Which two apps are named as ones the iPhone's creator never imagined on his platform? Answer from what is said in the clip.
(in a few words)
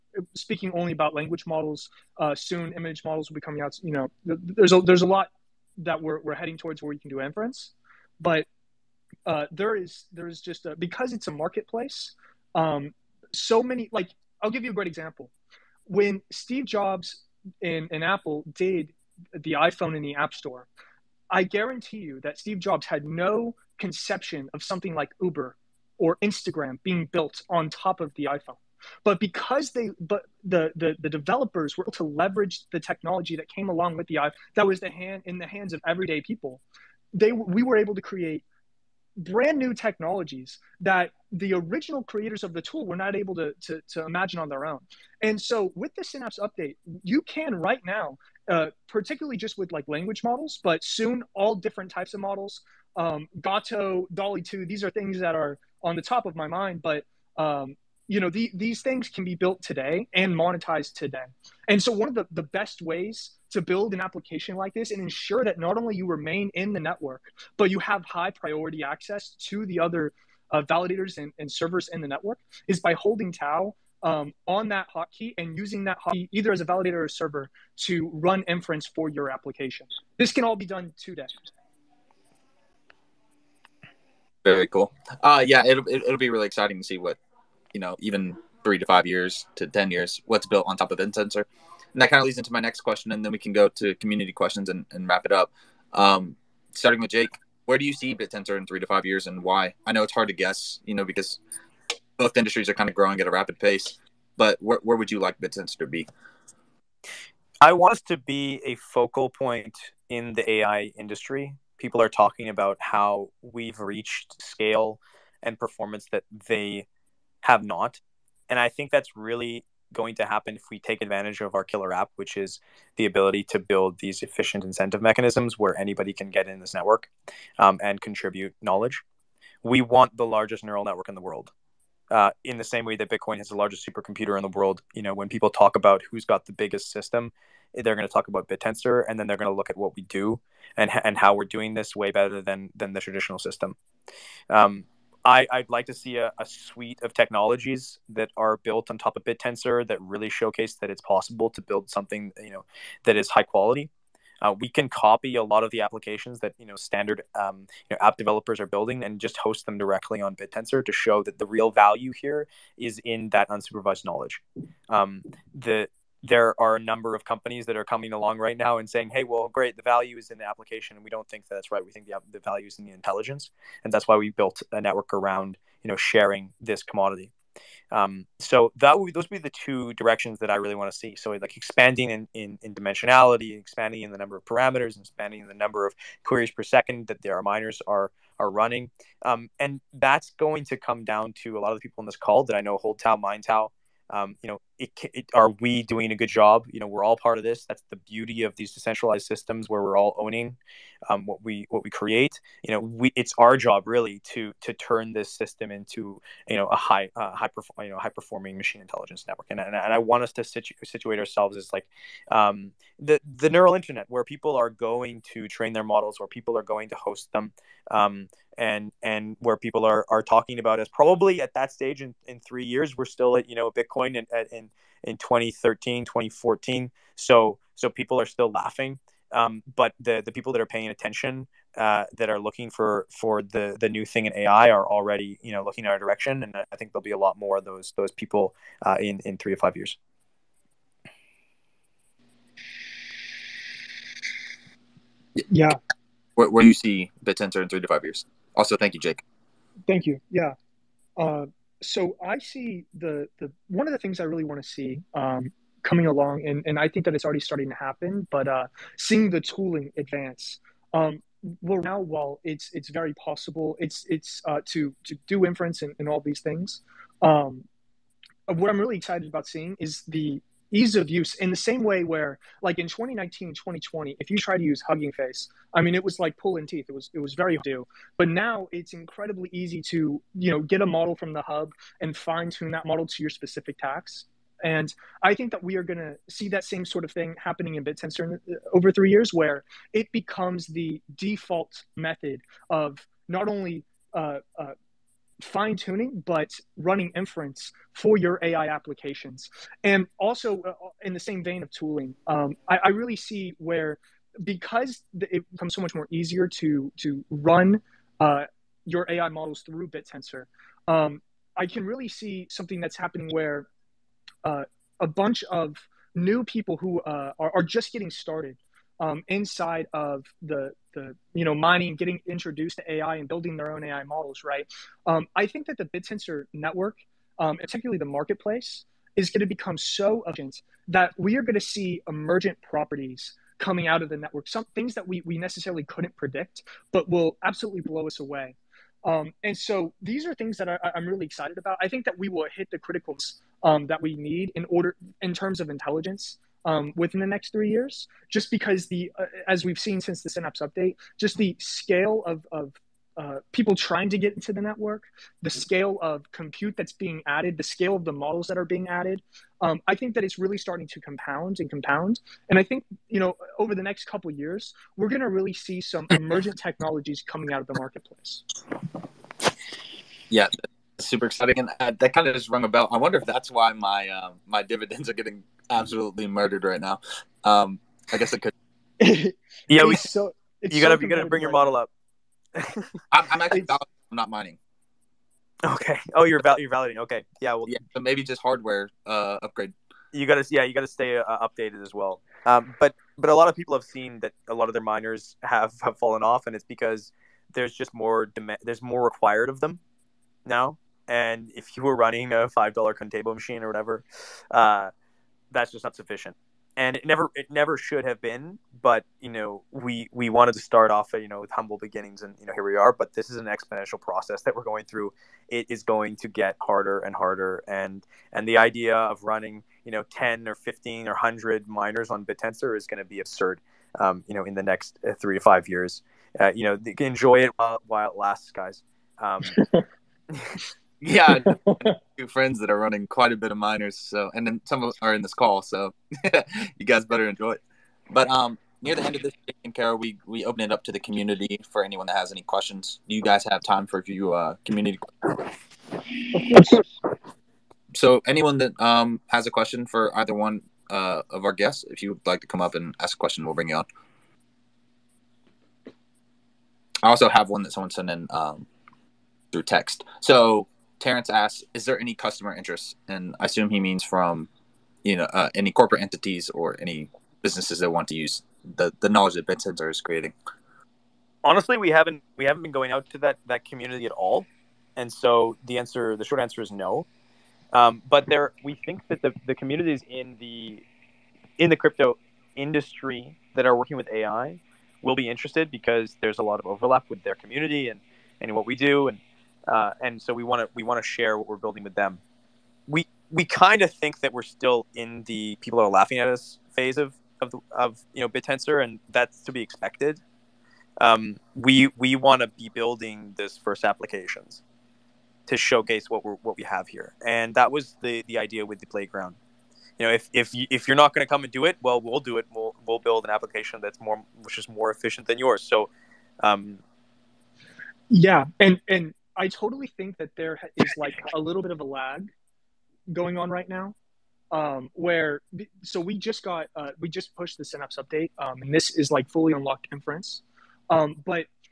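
Uber or Instagram.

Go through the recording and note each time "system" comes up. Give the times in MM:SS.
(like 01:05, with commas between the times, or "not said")
02:16, 02:23, 03:19, 03:25.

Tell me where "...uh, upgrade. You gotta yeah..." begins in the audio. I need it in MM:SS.
06:29.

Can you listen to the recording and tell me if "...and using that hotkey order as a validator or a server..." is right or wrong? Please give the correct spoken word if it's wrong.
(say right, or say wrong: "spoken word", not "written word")
wrong: "either", not "order".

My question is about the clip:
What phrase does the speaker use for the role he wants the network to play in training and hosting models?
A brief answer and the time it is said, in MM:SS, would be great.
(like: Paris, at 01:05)
the neural internet, at 03:33.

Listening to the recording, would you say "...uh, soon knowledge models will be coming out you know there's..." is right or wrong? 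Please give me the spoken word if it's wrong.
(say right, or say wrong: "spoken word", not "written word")
wrong: "image", not "knowledge".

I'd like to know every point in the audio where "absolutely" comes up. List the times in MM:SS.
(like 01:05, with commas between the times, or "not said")
05:37, 06:15.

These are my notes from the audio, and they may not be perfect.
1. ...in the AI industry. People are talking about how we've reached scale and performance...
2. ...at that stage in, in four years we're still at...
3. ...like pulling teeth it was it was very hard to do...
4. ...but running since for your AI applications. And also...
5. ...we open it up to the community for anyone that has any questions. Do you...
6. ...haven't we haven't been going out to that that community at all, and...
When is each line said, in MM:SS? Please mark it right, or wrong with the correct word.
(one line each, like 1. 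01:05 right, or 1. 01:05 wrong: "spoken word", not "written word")
1. 01:50 right
2. 03:41 wrong: "three", not "four"
3. 04:36 right
4. 04:56 wrong: "inference", not "since"
5. 07:20 right
6. 07:51 right.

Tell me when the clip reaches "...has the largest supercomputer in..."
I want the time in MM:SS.
02:13.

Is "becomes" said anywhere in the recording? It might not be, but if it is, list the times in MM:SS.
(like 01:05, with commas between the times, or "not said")
04:50, 05:05, 05:29.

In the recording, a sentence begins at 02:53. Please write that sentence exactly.
And that's why we built a network around you know sharing this commodity.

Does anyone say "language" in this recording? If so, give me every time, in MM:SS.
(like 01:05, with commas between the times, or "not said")
00:01, 00:49.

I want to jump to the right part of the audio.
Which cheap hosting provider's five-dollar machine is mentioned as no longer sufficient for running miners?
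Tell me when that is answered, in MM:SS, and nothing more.
06:42.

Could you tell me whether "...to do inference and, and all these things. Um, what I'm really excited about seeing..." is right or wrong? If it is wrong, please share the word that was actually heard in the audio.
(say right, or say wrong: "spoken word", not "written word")
right.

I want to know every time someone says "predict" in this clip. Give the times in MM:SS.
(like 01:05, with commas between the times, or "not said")
05:36.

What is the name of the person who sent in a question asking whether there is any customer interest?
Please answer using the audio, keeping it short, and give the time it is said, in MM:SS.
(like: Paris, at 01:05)
Terrence, at 07:41.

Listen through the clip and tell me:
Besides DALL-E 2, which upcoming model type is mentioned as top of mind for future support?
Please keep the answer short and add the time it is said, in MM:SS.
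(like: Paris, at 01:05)
Gato, at 00:53.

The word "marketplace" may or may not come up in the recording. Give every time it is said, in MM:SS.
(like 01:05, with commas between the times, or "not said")
00:11, 05:28, 06:07.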